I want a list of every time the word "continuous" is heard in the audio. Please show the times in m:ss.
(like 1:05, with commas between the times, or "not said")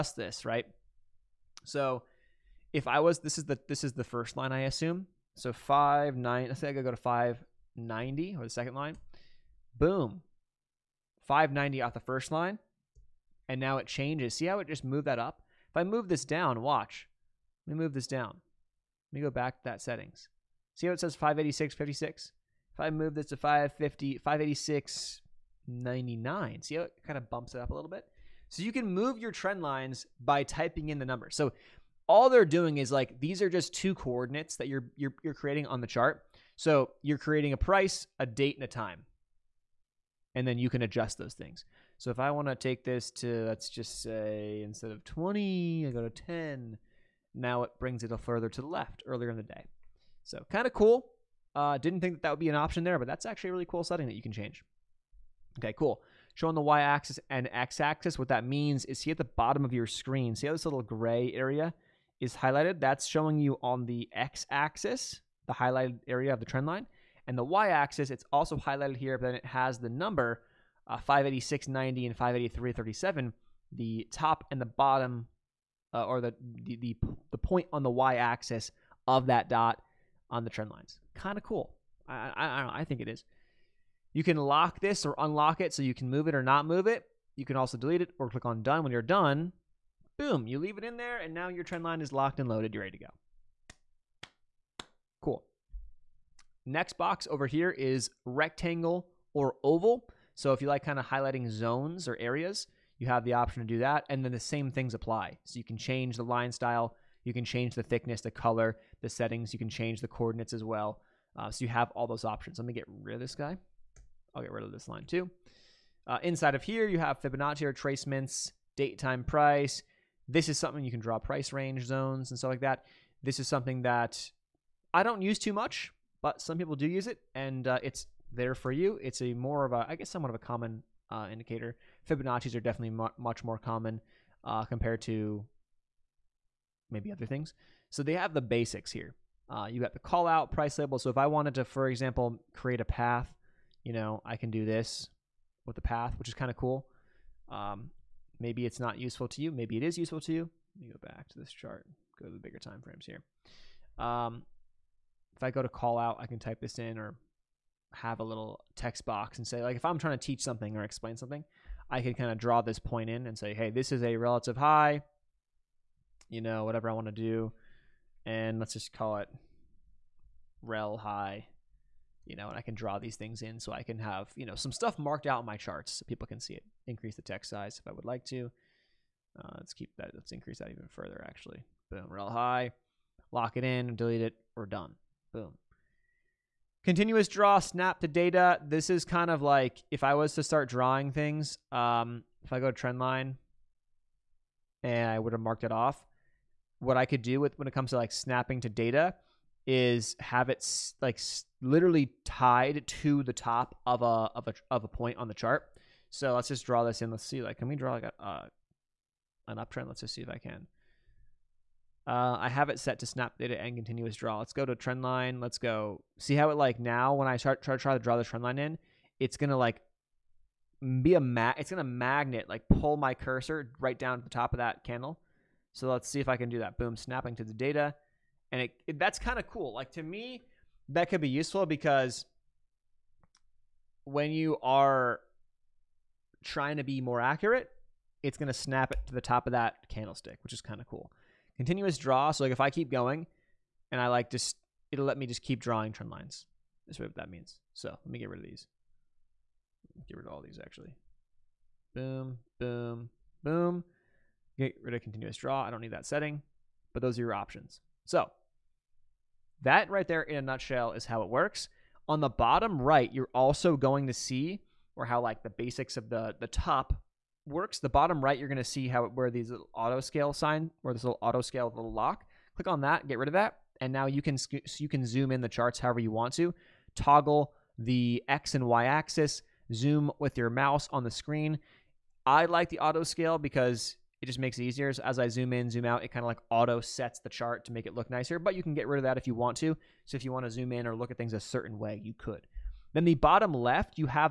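3:06, 3:33, 4:01, 4:15.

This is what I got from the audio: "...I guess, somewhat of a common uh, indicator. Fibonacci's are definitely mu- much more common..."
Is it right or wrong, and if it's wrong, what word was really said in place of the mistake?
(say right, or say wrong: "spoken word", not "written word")
right.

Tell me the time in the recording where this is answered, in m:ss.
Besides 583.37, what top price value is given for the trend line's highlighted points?
1:10.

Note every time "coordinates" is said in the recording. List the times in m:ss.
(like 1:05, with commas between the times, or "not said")
0:33, 1:50.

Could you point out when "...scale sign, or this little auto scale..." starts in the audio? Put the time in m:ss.
4:30.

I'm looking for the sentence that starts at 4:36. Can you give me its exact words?
Toggle the x and y axis, zoom with your mouse on the screen.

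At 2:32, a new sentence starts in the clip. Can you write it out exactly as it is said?
Go to the bigger time frames here.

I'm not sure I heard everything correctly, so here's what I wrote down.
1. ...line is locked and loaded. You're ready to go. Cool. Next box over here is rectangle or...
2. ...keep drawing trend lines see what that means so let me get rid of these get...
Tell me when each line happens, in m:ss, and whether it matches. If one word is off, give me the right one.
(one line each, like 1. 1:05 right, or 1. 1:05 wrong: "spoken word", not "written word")
1. 1:31 right
2. 4:05 right.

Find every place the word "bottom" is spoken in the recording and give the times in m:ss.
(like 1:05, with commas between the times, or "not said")
0:59, 1:14, 4:22, 4:27, 4:53.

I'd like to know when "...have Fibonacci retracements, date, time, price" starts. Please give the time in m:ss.
1:56.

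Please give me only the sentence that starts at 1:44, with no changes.
And then the same things apply.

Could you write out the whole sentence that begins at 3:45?
So let's see if I can do that.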